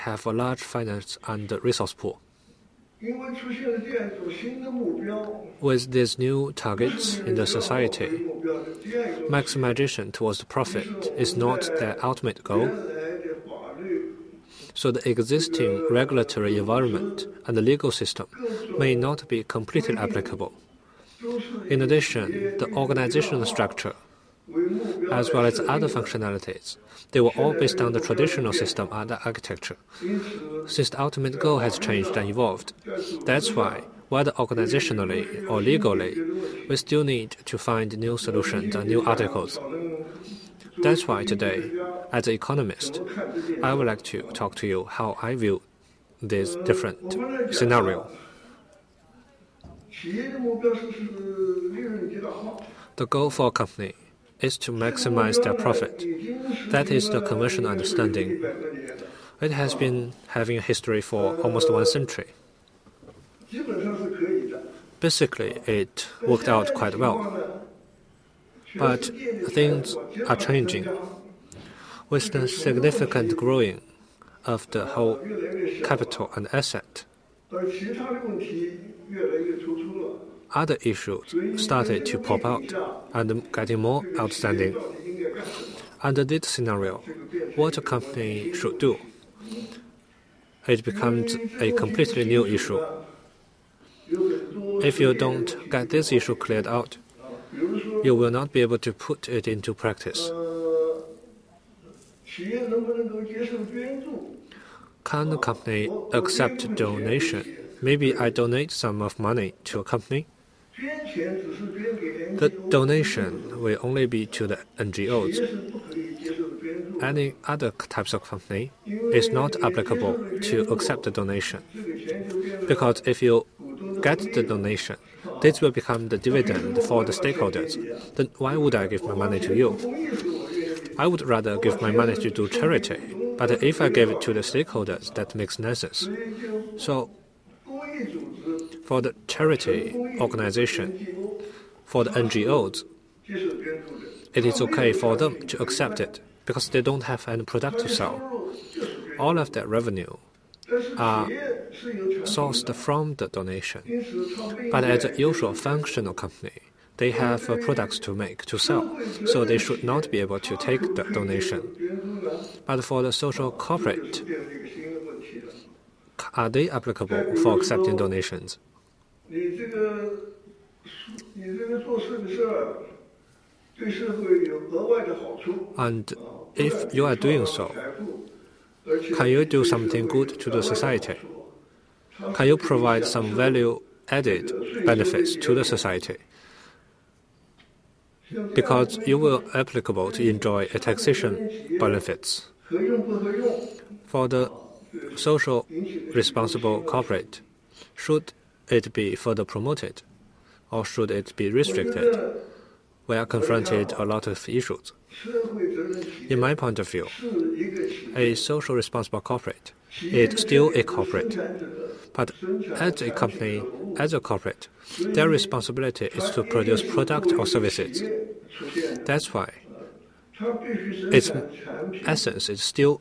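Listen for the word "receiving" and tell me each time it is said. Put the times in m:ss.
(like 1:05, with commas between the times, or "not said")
not said.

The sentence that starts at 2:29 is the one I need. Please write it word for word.
All of that revenue are sourced from the donation.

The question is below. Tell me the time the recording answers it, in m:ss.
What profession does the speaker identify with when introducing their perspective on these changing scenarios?
0:42.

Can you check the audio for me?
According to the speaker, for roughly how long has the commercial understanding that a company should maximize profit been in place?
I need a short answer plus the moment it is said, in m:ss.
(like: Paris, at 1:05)
almost one century, at 1:01.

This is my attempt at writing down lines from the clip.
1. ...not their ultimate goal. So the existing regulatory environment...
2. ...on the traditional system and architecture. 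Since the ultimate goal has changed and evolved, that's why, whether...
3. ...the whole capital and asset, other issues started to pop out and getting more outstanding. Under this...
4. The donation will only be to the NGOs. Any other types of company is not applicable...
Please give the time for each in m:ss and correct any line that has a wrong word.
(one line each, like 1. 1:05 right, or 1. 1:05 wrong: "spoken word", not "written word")
1. 0:11 right
2. 0:27 right
3. 1:14 right
4. 1:50 right.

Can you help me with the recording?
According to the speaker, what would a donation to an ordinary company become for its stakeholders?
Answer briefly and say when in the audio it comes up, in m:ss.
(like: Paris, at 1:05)
dividend, at 2:06.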